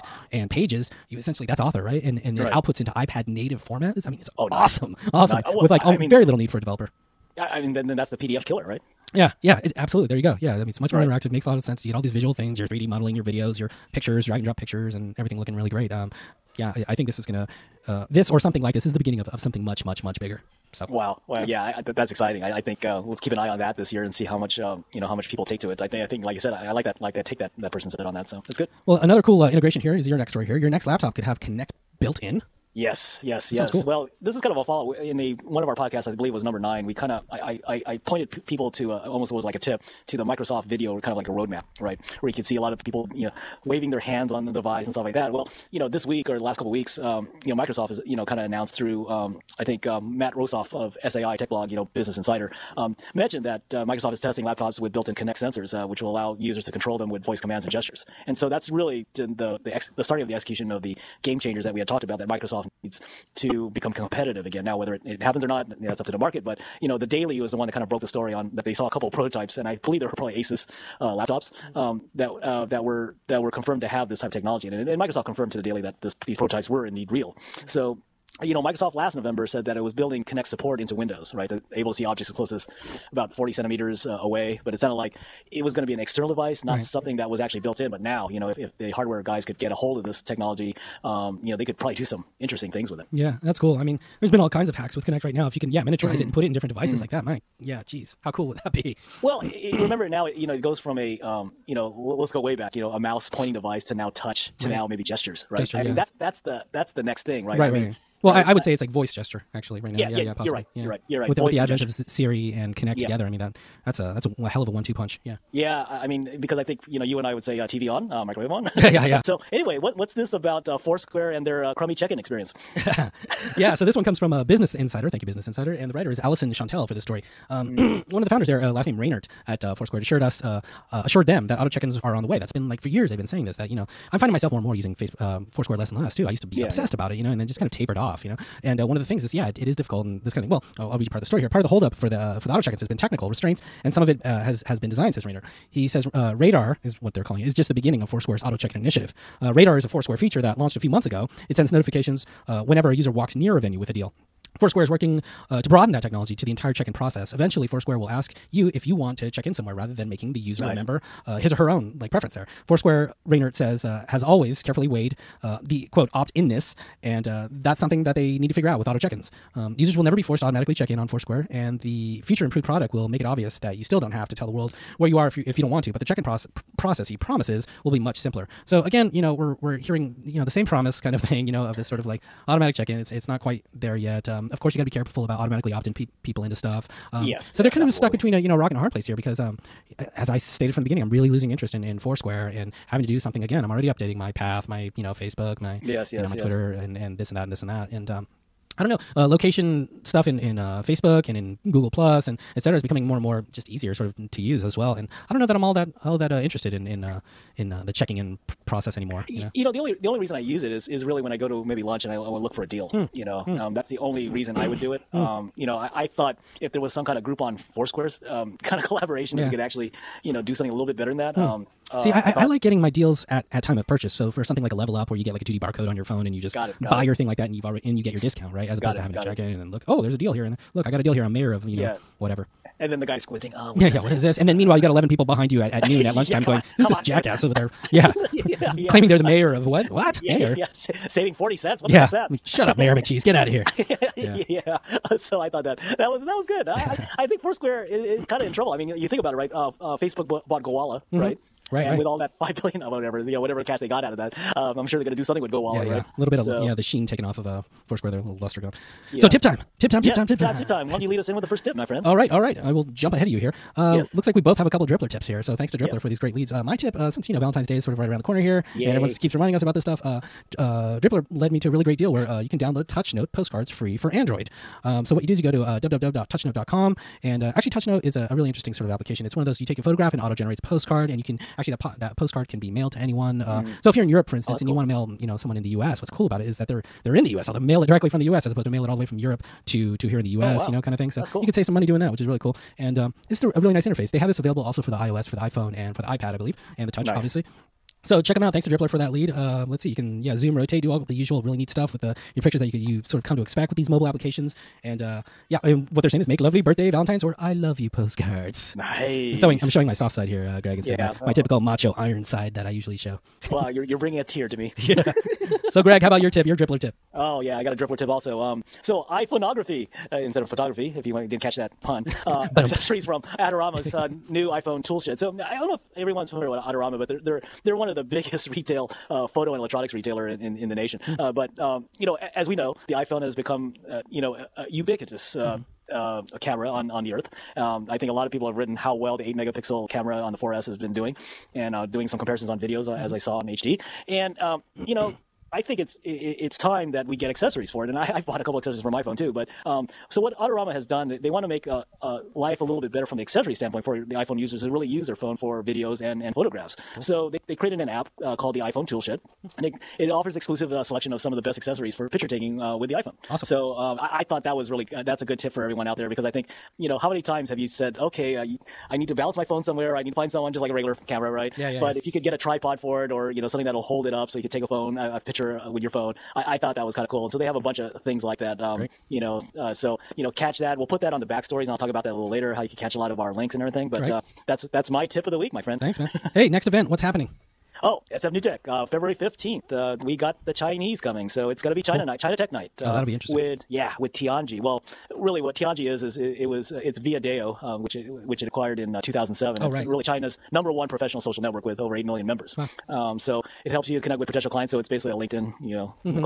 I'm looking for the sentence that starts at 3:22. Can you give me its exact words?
is becoming more and more just easier sort of to use as well.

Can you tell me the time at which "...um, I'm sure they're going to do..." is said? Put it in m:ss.
4:14.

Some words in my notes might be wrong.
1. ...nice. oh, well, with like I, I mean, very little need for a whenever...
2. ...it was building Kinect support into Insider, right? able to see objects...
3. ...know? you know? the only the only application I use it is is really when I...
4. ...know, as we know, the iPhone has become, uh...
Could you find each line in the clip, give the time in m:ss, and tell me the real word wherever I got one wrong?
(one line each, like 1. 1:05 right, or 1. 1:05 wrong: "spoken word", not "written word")
1. 0:05 wrong: "developer", not "whenever"
2. 1:19 wrong: "Windows", not "Insider"
3. 3:29 wrong: "reason", not "application"
4. 5:32 right.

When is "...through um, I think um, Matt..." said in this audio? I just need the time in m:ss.
0:48.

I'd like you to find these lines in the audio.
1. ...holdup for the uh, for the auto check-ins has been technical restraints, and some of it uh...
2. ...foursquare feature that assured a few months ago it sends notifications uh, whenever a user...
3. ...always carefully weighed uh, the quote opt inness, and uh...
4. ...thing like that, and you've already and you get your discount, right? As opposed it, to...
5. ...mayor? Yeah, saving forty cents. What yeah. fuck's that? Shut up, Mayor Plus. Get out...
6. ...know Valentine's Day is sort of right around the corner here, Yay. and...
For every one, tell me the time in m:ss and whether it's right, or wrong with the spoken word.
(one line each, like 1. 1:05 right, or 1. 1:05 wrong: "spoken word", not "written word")
1. 2:21 right
2. 2:29 wrong: "launched", not "assured"
3. 2:44 right
4. 3:47 right
5. 4:00 wrong: "McCheese", not "Plus"
6. 4:27 right.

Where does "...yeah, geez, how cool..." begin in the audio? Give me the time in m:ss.
1:37.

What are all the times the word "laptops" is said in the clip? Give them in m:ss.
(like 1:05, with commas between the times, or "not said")
0:30, 0:54, 1:11.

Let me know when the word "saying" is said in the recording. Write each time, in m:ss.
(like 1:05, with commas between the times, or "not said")
2:13, 5:06.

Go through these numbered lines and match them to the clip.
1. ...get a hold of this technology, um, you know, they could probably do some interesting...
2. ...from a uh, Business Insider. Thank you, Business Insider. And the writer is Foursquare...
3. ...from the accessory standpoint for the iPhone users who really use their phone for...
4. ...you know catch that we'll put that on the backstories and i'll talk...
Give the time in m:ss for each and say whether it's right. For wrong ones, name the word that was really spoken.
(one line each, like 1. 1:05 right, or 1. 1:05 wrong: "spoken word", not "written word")
1. 1:29 right
2. 2:04 wrong: "Allison", not "Foursquare"
3. 5:53 right
4. 6:20 right.